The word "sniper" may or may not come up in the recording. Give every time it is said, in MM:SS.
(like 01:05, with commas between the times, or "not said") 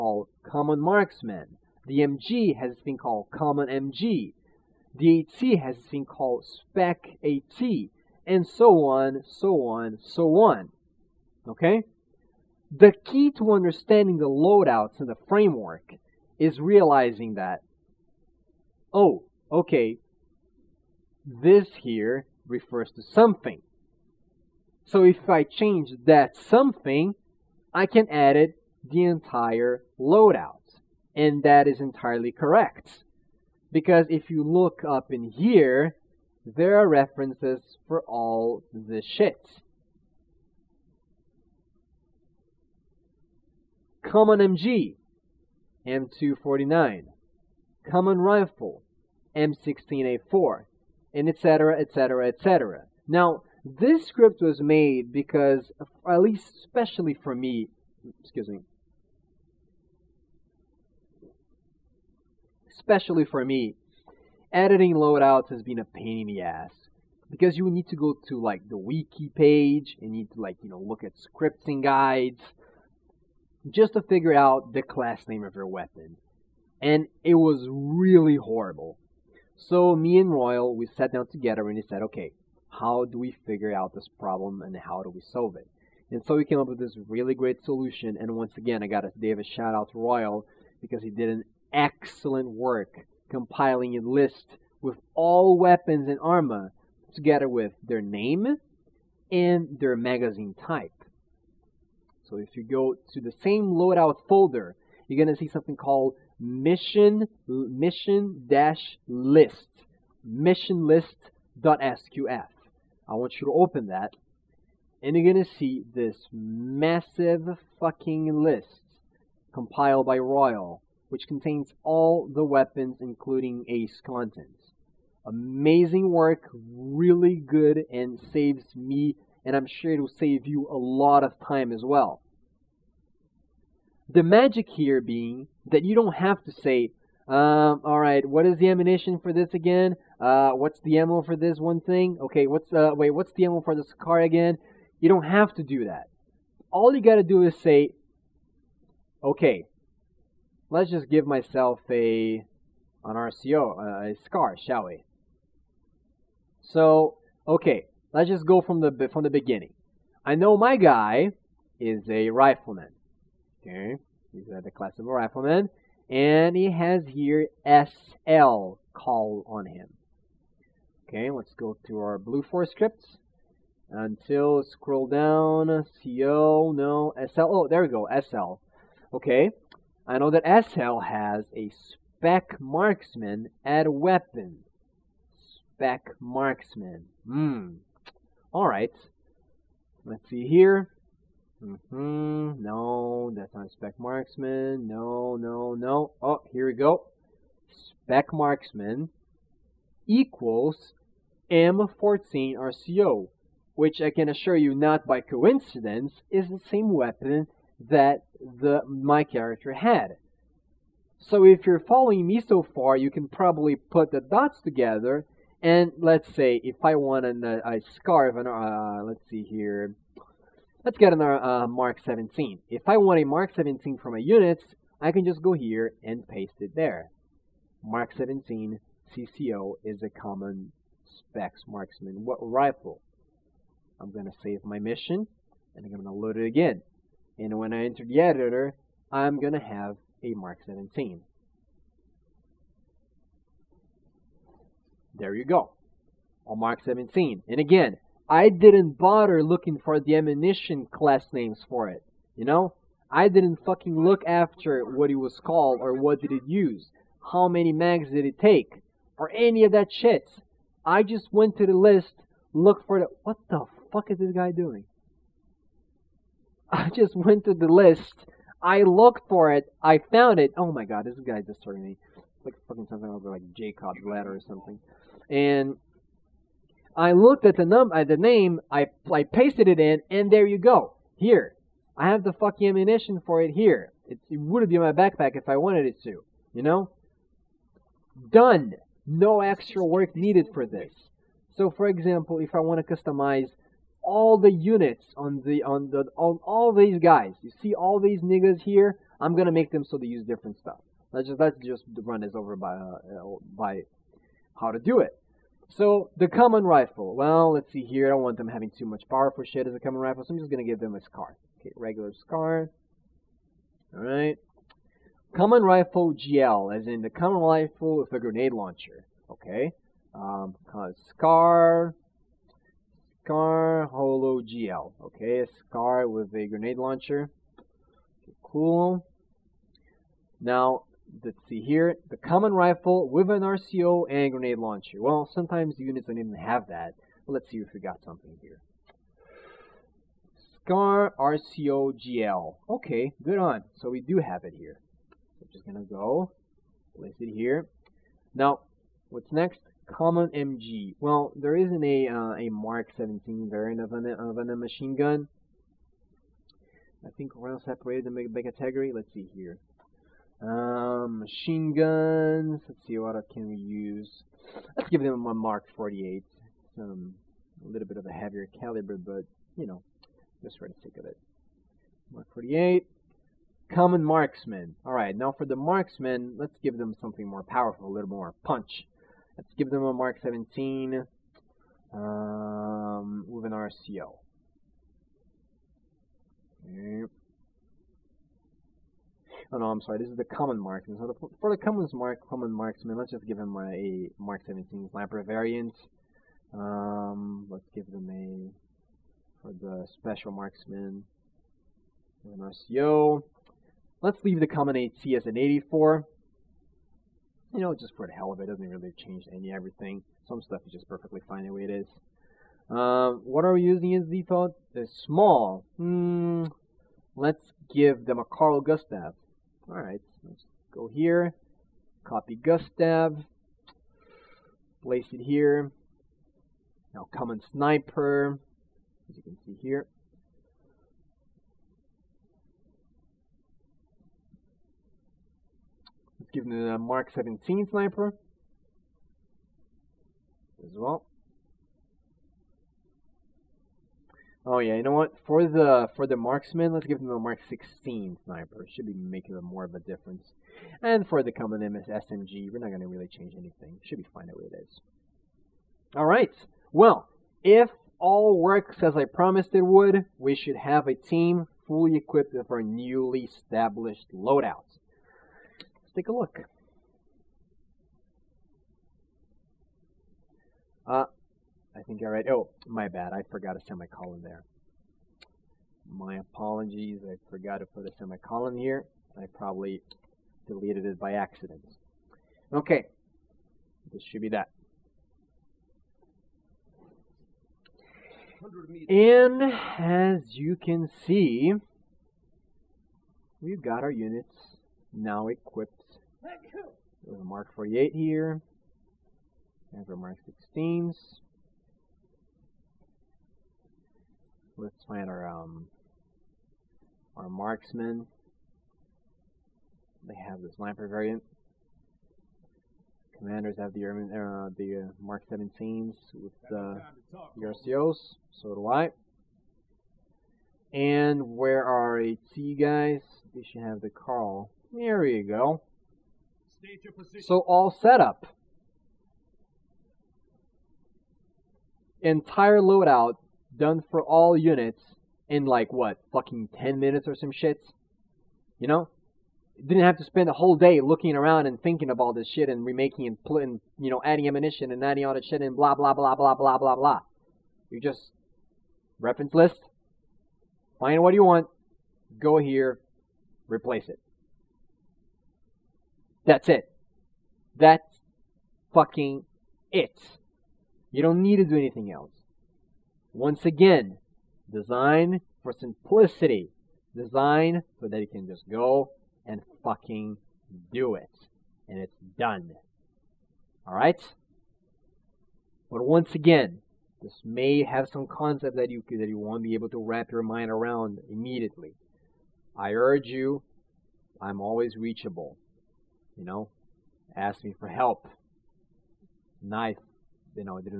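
06:34, 07:07, 07:17, 07:28, 08:30.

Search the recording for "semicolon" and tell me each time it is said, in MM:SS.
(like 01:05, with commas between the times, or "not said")
07:53, 07:57.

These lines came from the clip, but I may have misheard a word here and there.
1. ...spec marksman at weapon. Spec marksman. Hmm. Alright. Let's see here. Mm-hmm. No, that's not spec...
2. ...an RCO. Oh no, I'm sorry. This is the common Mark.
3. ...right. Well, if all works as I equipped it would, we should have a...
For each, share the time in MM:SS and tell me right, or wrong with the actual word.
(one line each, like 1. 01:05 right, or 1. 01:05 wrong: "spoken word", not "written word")
1. 03:01 right
2. 06:23 right
3. 07:36 wrong: "promised", not "equipped".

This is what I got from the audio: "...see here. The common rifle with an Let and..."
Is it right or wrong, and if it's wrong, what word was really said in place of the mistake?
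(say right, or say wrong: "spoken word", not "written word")
wrong: "RCO", not "Let".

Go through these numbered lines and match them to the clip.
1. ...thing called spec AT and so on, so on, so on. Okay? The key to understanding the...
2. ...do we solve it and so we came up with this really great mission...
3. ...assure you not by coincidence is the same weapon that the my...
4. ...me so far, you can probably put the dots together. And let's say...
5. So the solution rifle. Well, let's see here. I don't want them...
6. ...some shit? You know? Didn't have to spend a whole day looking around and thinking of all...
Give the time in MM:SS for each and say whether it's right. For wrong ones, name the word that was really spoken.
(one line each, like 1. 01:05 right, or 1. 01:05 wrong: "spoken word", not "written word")
1. 00:05 right
2. 01:25 wrong: "solution", not "mission"
3. 03:24 right
4. 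03:32 right
5. 05:05 wrong: "common", not "solution"
6. 08:57 right.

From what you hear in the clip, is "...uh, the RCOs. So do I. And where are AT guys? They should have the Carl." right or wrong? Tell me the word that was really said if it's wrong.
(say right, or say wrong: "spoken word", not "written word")
right.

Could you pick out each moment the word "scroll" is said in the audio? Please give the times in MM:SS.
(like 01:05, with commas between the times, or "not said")
02:54.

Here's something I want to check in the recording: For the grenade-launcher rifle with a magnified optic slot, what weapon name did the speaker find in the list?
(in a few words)
SCAR RCO GL.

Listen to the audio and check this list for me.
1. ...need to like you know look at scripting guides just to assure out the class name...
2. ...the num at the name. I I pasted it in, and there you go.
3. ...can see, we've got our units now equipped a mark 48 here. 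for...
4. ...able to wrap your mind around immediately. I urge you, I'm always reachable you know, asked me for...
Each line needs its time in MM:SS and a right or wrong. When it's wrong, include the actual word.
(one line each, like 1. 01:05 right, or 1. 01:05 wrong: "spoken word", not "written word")
1. 01:10 wrong: "figure", not "assure"
2. 04:37 right
3. 08:10 right
4. 09:39 right.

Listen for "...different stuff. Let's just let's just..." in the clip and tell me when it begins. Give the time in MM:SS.
05:00.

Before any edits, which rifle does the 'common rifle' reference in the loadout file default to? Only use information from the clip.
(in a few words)
M16A4.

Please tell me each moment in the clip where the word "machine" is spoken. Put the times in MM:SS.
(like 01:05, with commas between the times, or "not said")
05:54, 06:01.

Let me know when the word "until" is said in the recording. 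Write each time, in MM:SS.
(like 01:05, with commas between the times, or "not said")
02:53.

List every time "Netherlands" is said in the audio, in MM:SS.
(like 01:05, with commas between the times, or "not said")
not said.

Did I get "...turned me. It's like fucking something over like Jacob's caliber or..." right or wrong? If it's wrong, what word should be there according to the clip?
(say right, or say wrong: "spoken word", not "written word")
wrong: "ladder", not "caliber".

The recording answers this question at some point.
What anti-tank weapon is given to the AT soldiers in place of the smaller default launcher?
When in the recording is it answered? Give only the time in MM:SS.
06:58.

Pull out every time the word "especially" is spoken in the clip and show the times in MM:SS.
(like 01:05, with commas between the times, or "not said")
00:56, 01:02.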